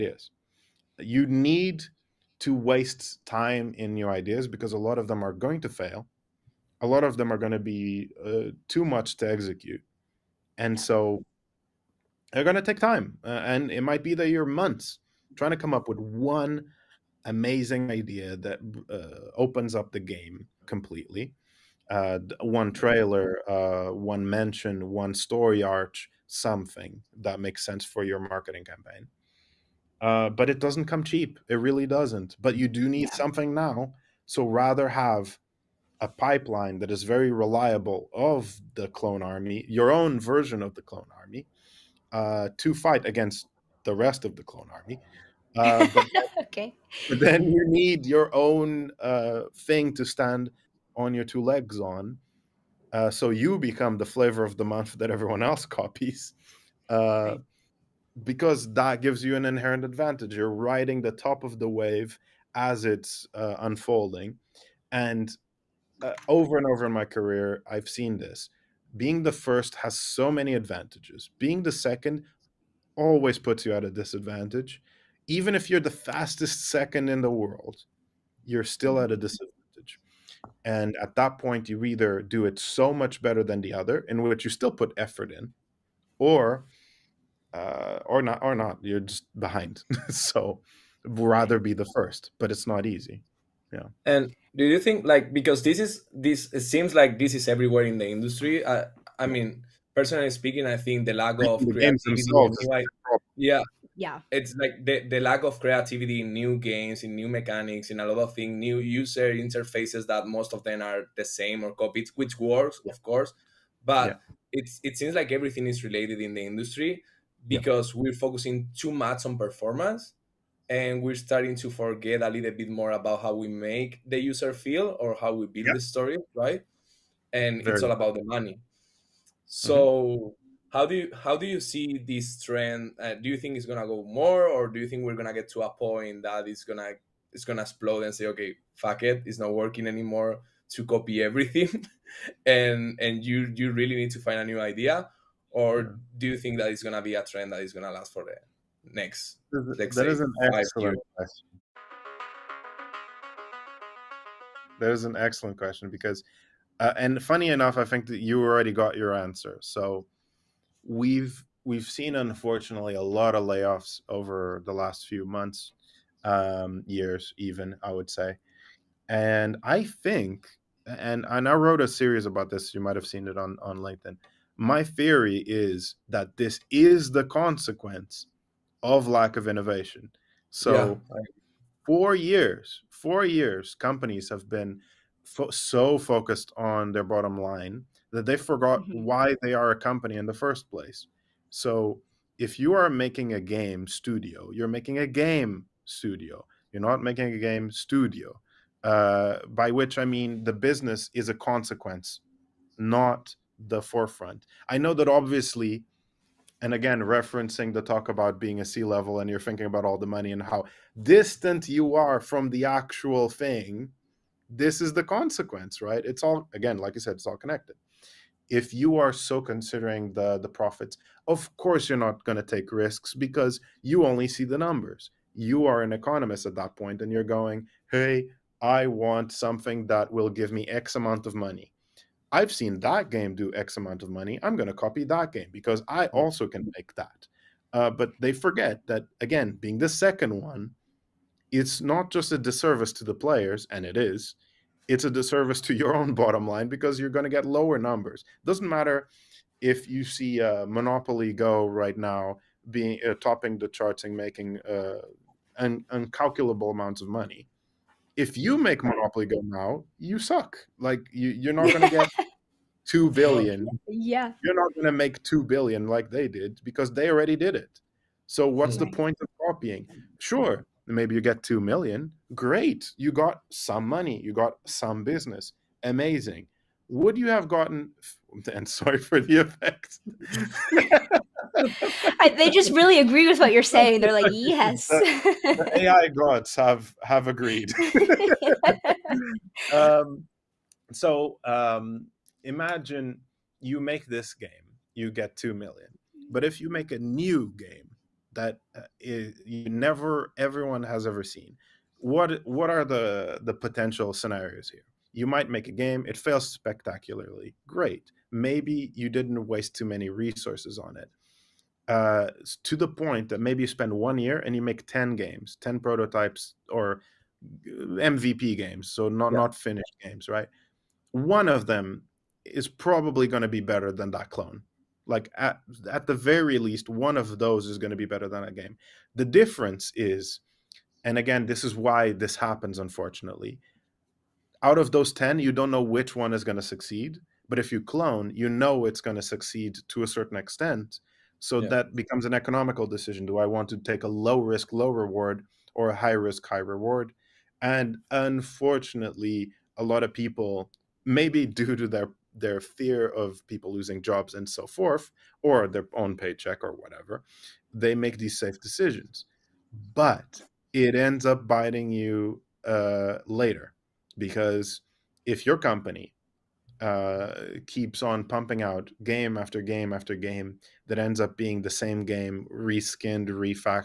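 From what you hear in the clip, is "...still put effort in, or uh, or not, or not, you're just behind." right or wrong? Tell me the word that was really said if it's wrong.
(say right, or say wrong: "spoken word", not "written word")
right.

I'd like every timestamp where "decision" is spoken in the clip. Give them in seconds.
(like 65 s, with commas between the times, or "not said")
342 s, 358 s.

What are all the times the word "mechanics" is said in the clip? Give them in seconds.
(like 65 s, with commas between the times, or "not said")
107 s.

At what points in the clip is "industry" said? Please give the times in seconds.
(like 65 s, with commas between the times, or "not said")
98 s, 116 s.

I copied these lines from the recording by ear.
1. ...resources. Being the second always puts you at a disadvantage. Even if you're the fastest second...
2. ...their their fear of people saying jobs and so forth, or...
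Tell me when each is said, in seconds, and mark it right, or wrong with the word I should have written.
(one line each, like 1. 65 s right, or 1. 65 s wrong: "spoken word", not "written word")
1. 70 s wrong: "advantages", not "resources"
2. 351 s wrong: "losing", not "saying".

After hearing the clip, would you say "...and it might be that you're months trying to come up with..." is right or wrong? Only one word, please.
right.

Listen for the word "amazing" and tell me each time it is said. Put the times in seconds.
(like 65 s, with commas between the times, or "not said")
17 s, 275 s.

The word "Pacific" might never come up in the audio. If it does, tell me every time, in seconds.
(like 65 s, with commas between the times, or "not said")
not said.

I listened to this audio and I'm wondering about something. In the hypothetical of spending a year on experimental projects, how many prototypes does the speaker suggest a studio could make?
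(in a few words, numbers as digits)
10.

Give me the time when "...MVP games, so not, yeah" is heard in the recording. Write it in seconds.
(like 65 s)
318 s.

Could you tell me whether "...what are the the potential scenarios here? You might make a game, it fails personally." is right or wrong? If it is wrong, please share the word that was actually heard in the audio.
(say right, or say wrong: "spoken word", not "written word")
wrong: "spectacularly", not "personally".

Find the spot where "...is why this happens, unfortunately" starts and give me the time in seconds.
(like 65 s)
331 s.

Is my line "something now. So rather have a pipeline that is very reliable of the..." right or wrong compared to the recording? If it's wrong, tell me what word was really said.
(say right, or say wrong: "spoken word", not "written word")
right.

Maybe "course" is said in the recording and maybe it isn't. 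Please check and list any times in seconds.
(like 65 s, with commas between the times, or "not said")
113 s, 221 s.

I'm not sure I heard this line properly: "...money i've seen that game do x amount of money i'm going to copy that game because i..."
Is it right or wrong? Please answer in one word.
right.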